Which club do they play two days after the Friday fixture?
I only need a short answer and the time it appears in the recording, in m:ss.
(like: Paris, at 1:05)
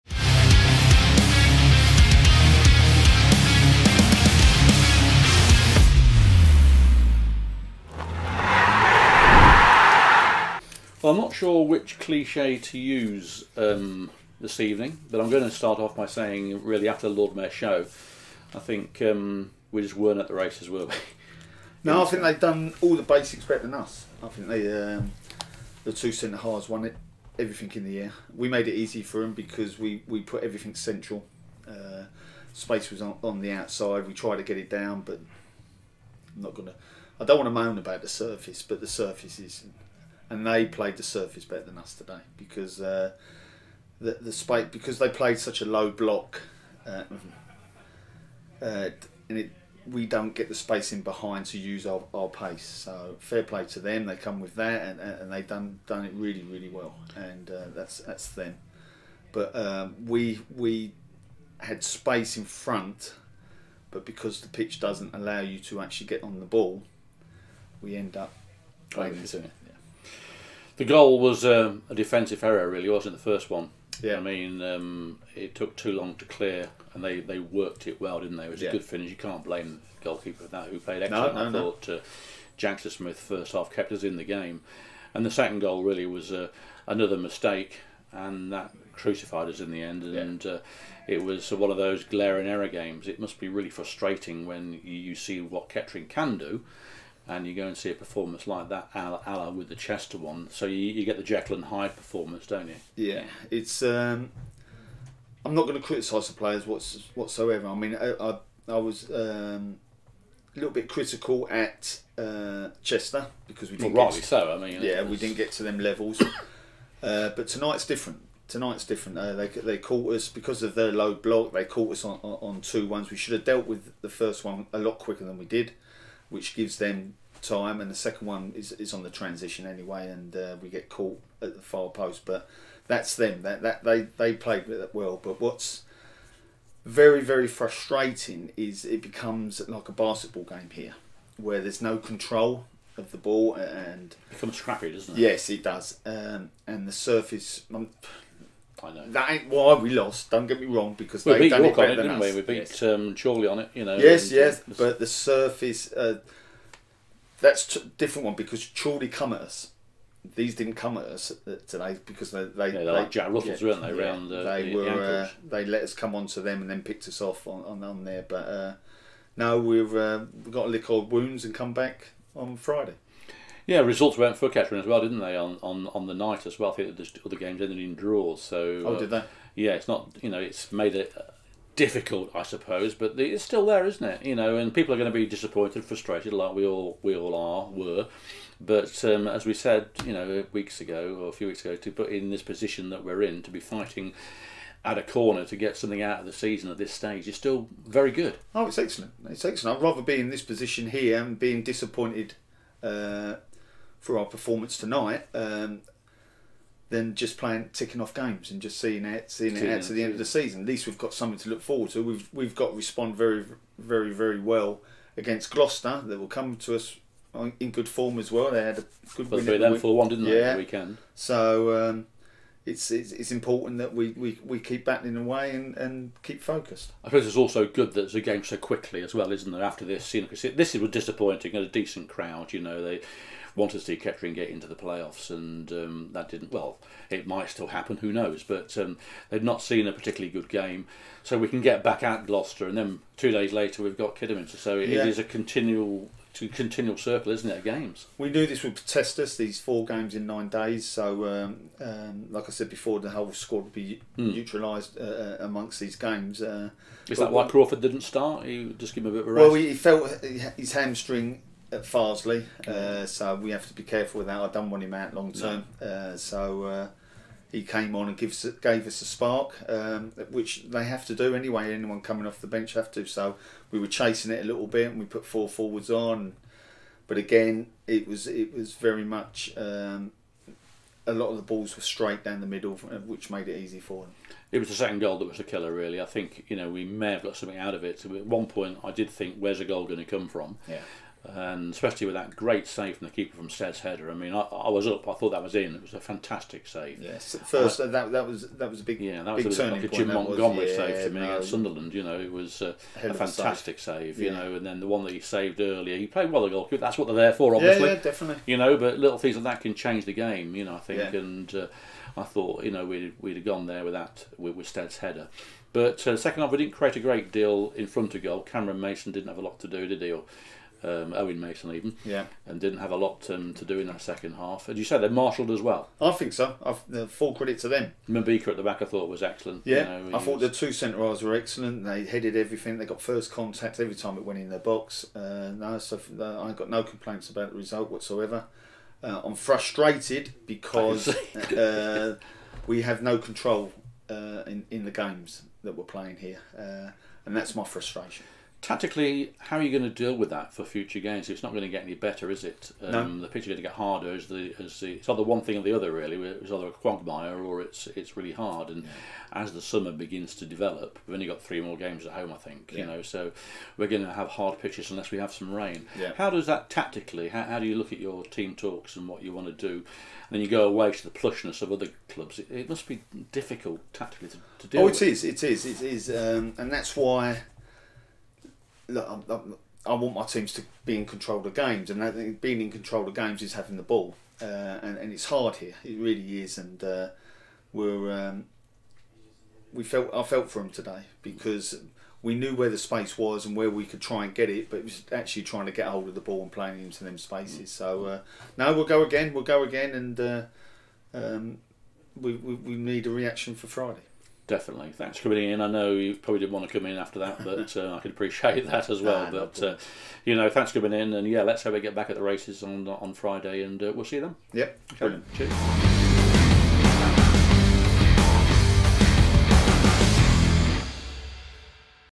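Kidderminster, at 4:04.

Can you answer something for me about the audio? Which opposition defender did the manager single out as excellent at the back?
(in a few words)
Mabika.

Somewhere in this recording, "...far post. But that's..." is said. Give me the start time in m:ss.
2:11.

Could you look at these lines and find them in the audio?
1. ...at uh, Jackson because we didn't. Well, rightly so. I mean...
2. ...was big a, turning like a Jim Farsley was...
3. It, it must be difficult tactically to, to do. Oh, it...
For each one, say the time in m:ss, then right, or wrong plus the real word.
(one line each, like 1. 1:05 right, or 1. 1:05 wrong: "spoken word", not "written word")
1. 1:51 wrong: "Chester", not "Jackson"
2. 4:59 wrong: "Montgomery", not "Farsley"
3. 6:12 right.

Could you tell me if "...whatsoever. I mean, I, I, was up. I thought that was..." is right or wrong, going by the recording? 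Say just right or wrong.
wrong.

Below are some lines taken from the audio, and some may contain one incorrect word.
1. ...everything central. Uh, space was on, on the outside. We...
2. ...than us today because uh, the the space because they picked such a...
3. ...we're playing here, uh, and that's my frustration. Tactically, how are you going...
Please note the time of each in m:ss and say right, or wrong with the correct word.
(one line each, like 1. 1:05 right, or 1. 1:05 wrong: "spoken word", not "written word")
1. 0:30 right
2. 0:41 wrong: "played", not "picked"
3. 5:45 right.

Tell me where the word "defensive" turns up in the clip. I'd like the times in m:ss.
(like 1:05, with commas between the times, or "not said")
1:11.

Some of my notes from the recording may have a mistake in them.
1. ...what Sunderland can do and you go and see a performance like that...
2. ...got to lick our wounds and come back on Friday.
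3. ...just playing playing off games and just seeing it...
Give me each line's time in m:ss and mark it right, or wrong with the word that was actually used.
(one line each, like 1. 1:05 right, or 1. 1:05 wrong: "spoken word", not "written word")
1. 1:35 wrong: "Kettering", not "Sunderland"
2. 2:50 right
3. 3:27 wrong: "ticking", not "playing".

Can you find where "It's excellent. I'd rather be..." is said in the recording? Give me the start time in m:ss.
3:19.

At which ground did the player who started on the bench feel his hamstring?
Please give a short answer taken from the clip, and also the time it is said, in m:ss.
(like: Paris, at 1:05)
Farsley, at 4:21.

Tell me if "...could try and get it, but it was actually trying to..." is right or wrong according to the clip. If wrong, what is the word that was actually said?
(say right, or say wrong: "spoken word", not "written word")
right.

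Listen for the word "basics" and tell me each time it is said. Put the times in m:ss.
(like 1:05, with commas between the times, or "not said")
0:23.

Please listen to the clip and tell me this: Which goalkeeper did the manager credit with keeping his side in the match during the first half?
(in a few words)
Jackson Smith.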